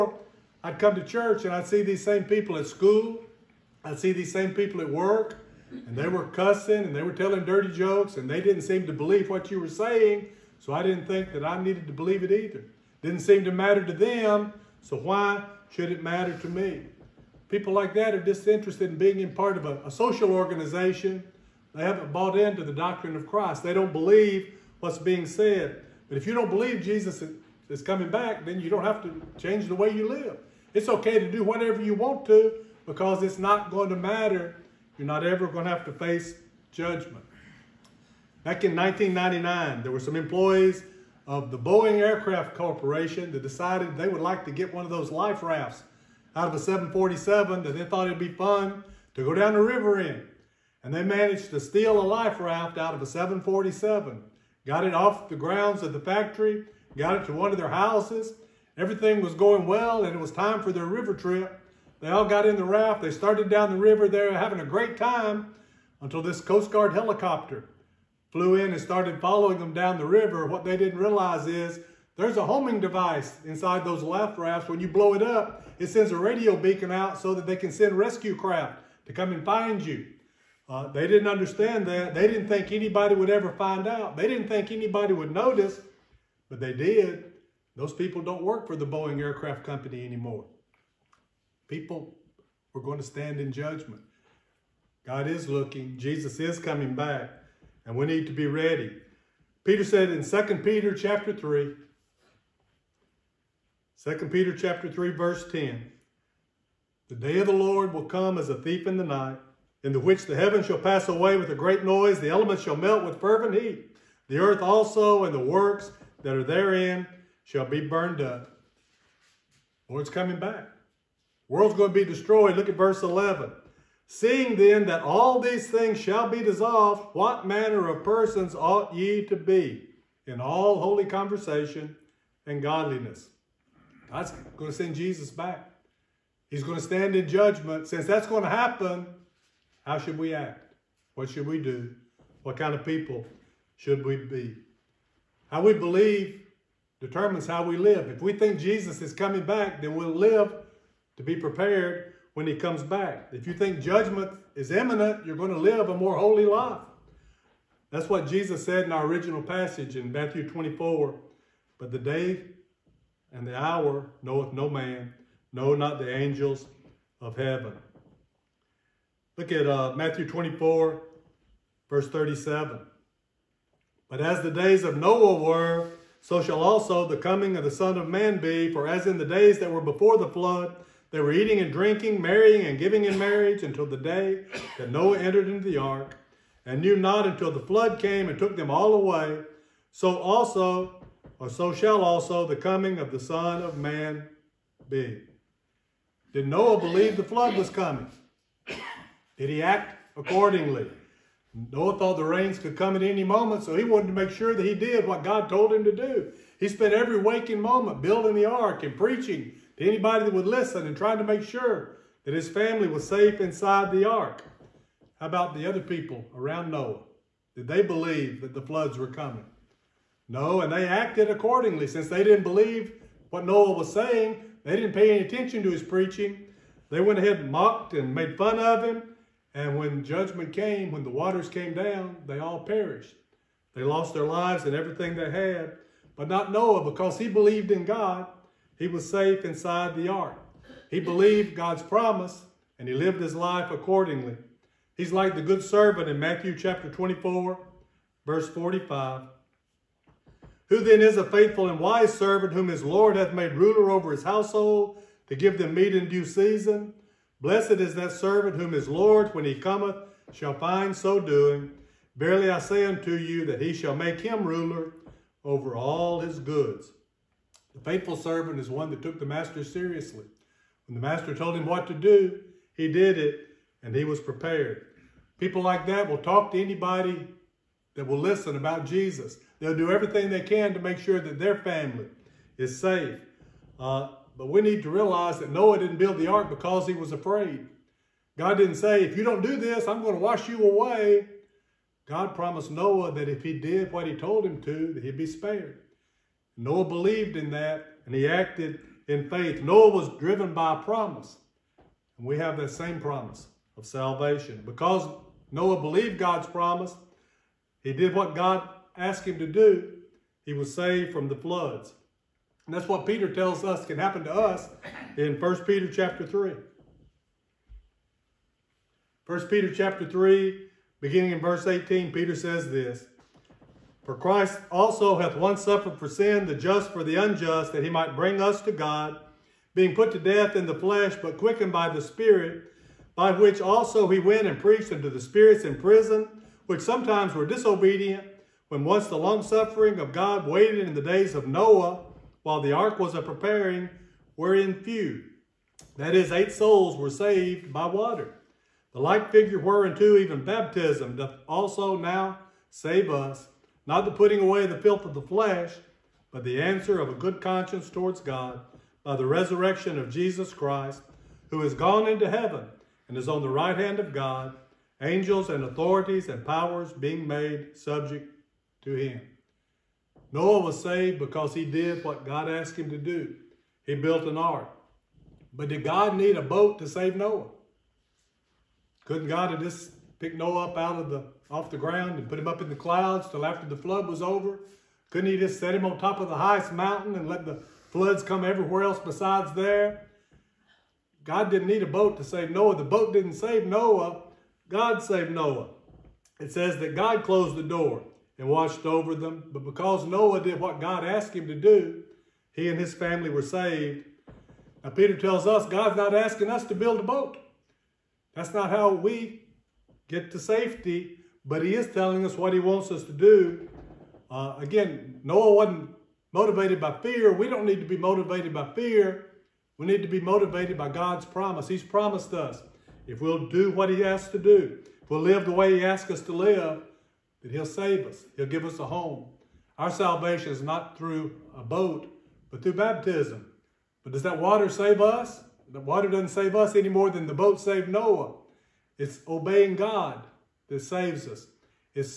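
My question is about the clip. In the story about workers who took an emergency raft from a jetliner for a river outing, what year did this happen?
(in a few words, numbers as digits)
1999.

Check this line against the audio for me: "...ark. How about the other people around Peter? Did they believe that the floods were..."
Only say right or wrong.
wrong.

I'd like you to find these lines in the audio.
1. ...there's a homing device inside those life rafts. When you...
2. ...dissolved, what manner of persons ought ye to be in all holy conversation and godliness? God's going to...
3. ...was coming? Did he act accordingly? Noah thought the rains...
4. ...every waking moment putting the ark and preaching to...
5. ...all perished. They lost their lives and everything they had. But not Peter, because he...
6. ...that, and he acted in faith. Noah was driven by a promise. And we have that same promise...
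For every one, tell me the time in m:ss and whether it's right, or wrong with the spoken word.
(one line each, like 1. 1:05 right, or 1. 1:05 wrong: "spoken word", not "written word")
1. 1:12 right
2. 2:06 right
3. 3:17 right
4. 3:26 wrong: "building", not "putting"
5. 3:52 wrong: "Noah", not "Peter"
6. 4:57 right.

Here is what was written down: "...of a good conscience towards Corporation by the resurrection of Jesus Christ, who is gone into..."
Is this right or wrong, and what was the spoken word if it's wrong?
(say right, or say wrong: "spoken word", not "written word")
wrong: "God", not "Corporation".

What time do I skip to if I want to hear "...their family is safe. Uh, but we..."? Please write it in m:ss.
4:41.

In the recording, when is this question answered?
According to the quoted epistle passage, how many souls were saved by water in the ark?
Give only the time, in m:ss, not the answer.
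5:46.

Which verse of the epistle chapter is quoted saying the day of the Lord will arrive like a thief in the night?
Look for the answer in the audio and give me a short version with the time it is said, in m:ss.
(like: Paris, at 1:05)
Verse 10, at 1:45.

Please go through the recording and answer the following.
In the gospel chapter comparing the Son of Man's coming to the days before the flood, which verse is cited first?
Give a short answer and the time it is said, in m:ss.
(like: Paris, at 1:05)
Verse 37, at 2:51.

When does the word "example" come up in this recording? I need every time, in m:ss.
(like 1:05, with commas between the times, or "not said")
not said.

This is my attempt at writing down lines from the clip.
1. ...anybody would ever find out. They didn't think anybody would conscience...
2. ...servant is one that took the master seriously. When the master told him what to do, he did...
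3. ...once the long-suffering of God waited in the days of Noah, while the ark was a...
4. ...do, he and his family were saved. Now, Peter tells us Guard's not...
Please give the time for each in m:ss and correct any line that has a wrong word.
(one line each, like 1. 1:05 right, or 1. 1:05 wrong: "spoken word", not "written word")
1. 1:22 wrong: "notice", not "conscience"
2. 4:28 right
3. 5:38 right
4. 6:41 wrong: "God", not "Guard".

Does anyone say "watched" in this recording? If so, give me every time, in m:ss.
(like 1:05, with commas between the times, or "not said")
6:38.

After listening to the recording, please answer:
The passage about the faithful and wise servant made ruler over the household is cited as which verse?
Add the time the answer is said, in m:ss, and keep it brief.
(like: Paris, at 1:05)
Verse 45, at 4:08.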